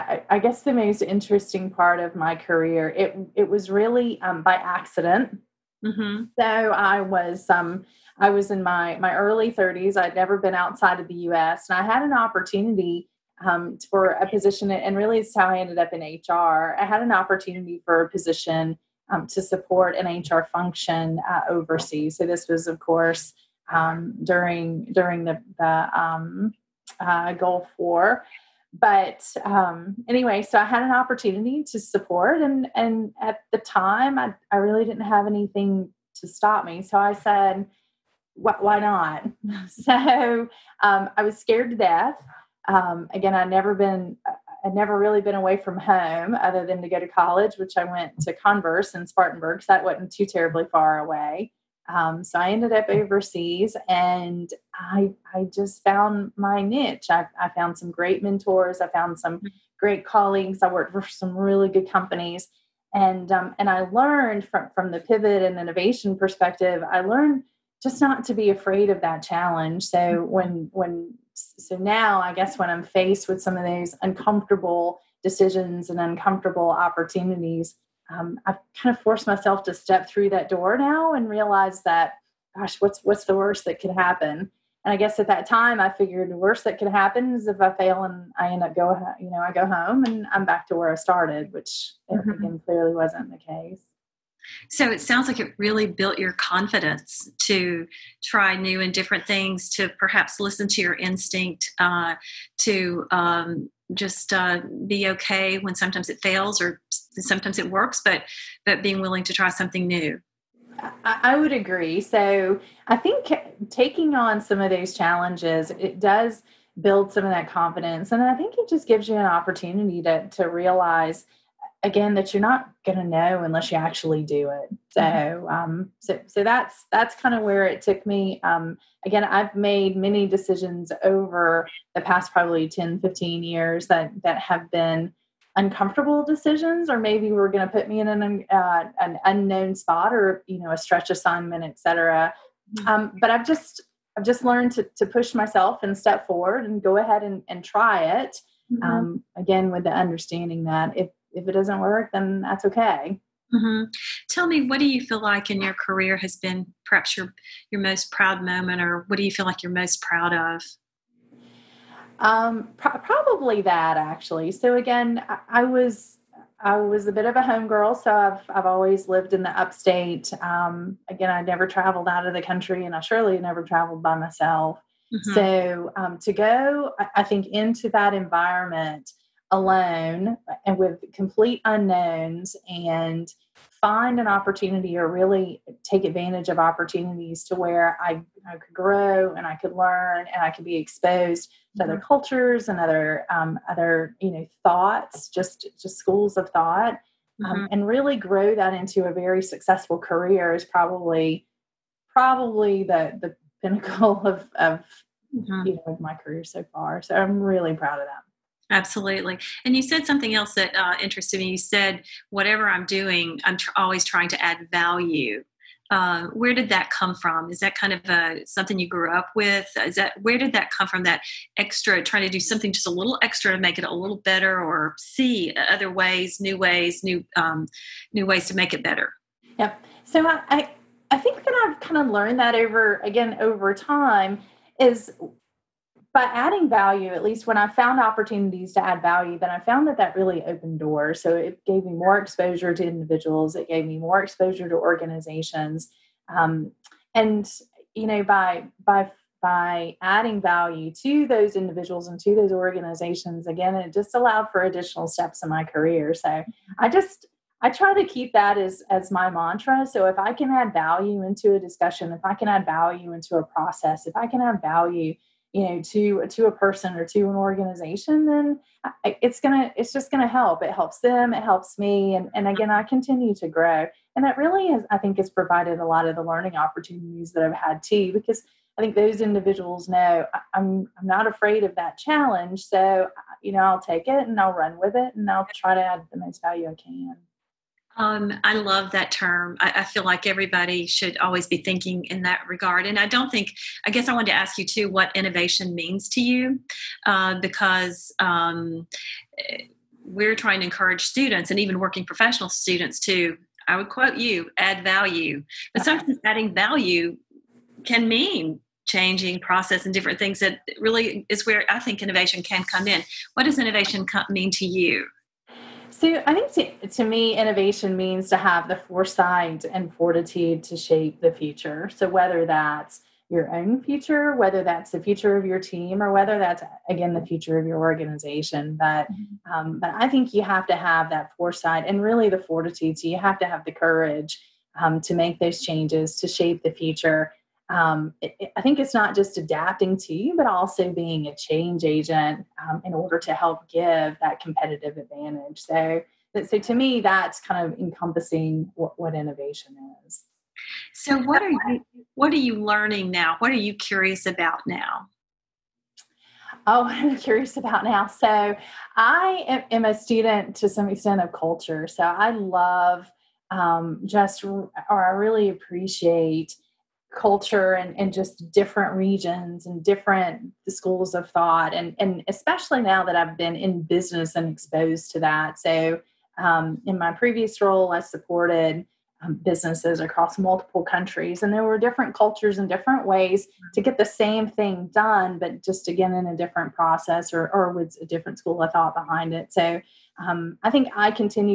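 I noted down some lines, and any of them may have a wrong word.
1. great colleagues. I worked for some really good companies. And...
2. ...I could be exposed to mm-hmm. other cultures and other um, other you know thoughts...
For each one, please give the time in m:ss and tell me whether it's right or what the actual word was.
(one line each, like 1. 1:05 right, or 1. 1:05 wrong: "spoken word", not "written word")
1. 0:59 right
2. 3:10 right.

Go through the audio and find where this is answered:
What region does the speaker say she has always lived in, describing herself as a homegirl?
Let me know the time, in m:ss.
2:49.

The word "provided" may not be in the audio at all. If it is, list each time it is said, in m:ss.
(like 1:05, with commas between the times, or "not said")
4:35.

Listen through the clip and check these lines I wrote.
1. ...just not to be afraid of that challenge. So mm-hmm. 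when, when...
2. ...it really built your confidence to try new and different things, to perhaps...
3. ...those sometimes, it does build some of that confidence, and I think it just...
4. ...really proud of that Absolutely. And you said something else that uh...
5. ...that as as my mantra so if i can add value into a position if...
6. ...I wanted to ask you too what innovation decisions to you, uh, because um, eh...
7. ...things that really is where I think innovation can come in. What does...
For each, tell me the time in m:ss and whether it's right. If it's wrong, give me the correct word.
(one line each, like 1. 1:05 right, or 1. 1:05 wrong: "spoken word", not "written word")
1. 1:07 right
2. 1:35 right
3. 1:54 wrong: "challenges", not "sometimes"
4. 3:27 right
5. 4:18 wrong: "discussion", not "position"
6. 4:54 wrong: "means", not "decisions"
7. 5:10 right.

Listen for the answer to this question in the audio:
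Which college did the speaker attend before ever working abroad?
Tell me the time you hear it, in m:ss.
0:48.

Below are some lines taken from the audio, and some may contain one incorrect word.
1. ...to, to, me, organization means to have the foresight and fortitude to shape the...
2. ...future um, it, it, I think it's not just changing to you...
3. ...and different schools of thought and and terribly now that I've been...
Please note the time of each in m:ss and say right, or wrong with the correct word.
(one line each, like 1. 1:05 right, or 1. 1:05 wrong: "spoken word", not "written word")
1. 5:16 wrong: "innovation", not "organization"
2. 5:36 wrong: "adapting", not "changing"
3. 6:09 wrong: "especially", not "terribly".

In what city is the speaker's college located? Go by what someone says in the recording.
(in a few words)
Spartanburg.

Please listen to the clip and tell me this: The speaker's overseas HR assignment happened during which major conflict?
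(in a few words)
Gulf War.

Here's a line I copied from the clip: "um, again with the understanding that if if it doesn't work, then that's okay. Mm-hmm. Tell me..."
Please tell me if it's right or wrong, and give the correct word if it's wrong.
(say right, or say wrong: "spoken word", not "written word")
right.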